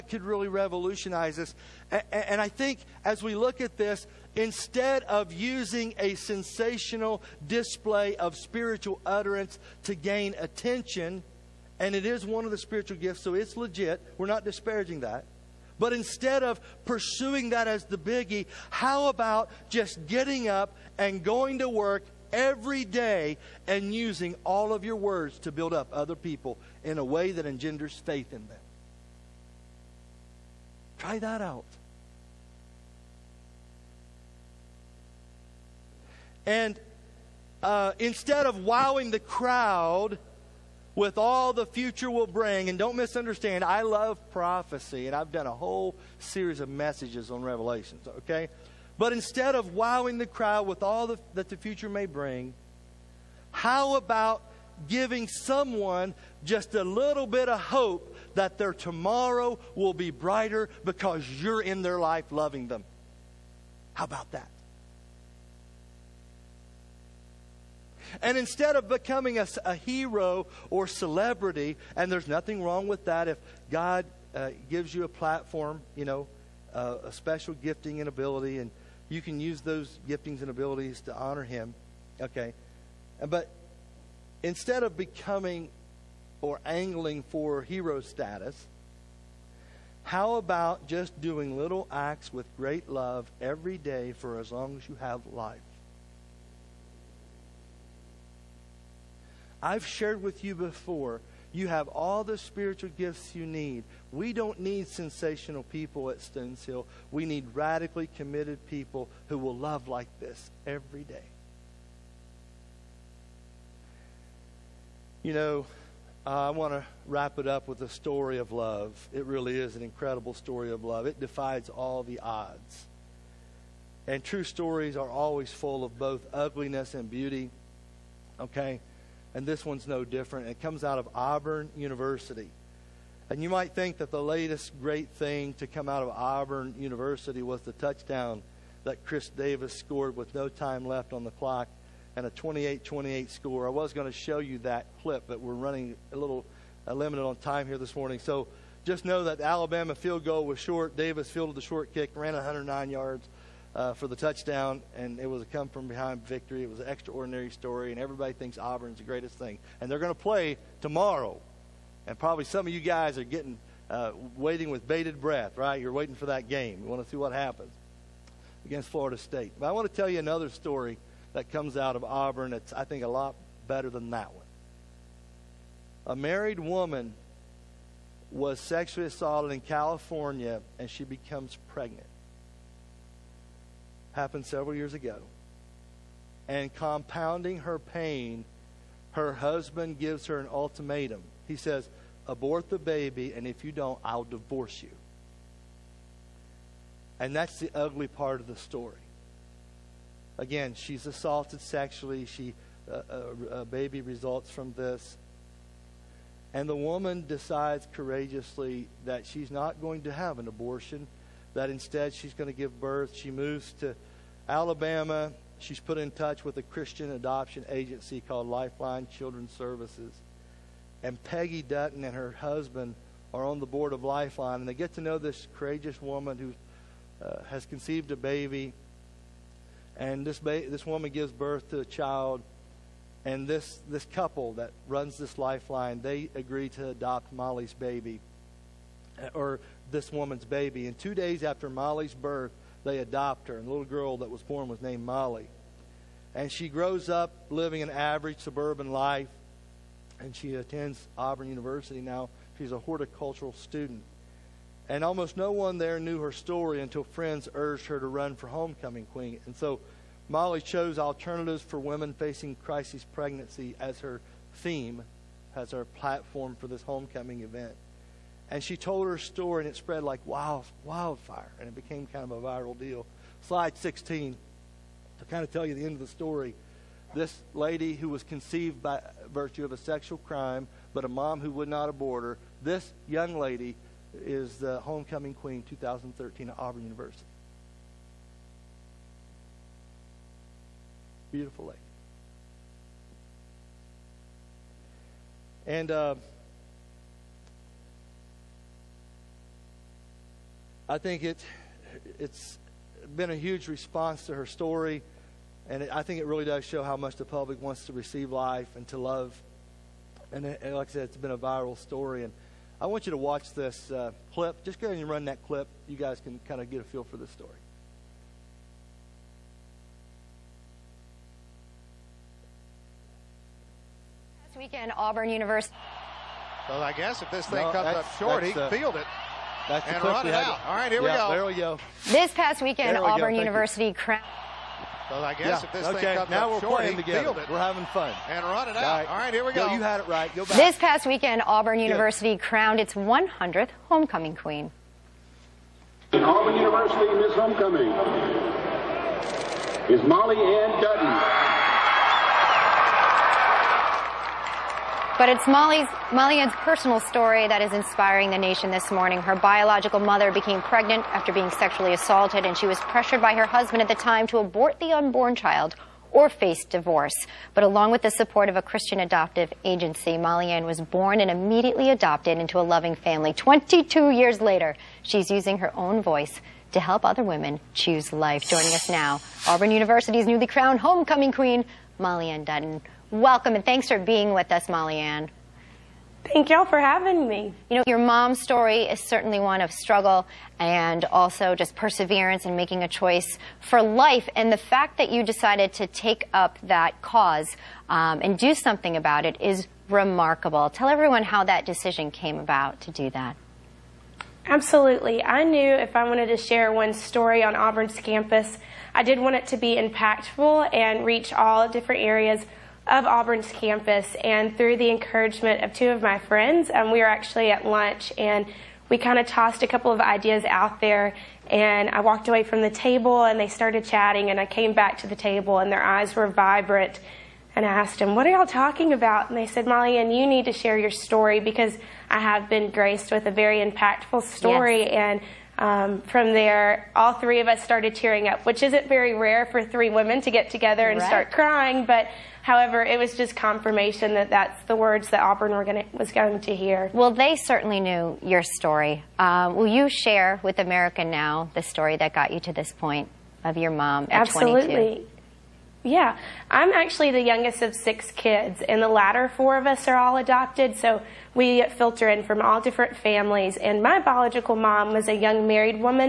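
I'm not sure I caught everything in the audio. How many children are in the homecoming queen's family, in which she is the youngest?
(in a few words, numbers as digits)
6.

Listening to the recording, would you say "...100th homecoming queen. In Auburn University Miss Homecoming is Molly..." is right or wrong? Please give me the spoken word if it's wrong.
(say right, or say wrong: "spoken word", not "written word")
right.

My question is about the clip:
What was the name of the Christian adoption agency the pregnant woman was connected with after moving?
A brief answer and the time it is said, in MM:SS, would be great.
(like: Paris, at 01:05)
Lifeline Children's Services, at 03:38.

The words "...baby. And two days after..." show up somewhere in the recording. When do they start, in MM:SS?
04:00.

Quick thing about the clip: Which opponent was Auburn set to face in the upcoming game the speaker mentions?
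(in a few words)
Florida State.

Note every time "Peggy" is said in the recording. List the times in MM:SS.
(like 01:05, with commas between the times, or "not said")
03:41.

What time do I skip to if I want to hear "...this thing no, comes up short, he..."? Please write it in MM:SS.
05:27.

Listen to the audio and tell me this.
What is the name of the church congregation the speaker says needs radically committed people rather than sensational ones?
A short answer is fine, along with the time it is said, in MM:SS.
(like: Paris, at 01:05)
Stones Hill, at 01:46.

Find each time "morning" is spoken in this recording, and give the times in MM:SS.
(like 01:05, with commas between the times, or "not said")
02:27, 05:58.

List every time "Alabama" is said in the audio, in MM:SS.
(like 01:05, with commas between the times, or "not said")
02:29, 03:34.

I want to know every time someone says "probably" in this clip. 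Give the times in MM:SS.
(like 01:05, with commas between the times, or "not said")
02:42.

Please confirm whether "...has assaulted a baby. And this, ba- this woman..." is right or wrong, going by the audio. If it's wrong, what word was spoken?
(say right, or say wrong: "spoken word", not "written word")
wrong: "conceived", not "assaulted".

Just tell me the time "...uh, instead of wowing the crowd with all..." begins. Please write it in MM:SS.
00:37.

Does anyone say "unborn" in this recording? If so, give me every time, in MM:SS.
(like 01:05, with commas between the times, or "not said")
06:04.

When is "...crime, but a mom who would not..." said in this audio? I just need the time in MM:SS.
04:40.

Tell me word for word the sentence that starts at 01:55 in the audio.
You know, I want to wrap it up with a story of love.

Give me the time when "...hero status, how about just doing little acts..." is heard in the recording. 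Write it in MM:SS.
01:27.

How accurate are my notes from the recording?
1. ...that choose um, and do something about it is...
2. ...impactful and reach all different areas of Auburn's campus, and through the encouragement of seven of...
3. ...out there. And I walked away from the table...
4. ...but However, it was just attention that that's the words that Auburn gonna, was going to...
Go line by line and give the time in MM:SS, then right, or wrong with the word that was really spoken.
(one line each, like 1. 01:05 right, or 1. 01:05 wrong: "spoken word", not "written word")
1. 06:36 wrong: "cause", not "choose"
2. 06:49 wrong: "two", not "seven"
3. 07:00 right
4. 07:21 wrong: "confirmation", not "attention".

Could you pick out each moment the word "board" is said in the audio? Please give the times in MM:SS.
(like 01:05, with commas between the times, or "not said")
03:43.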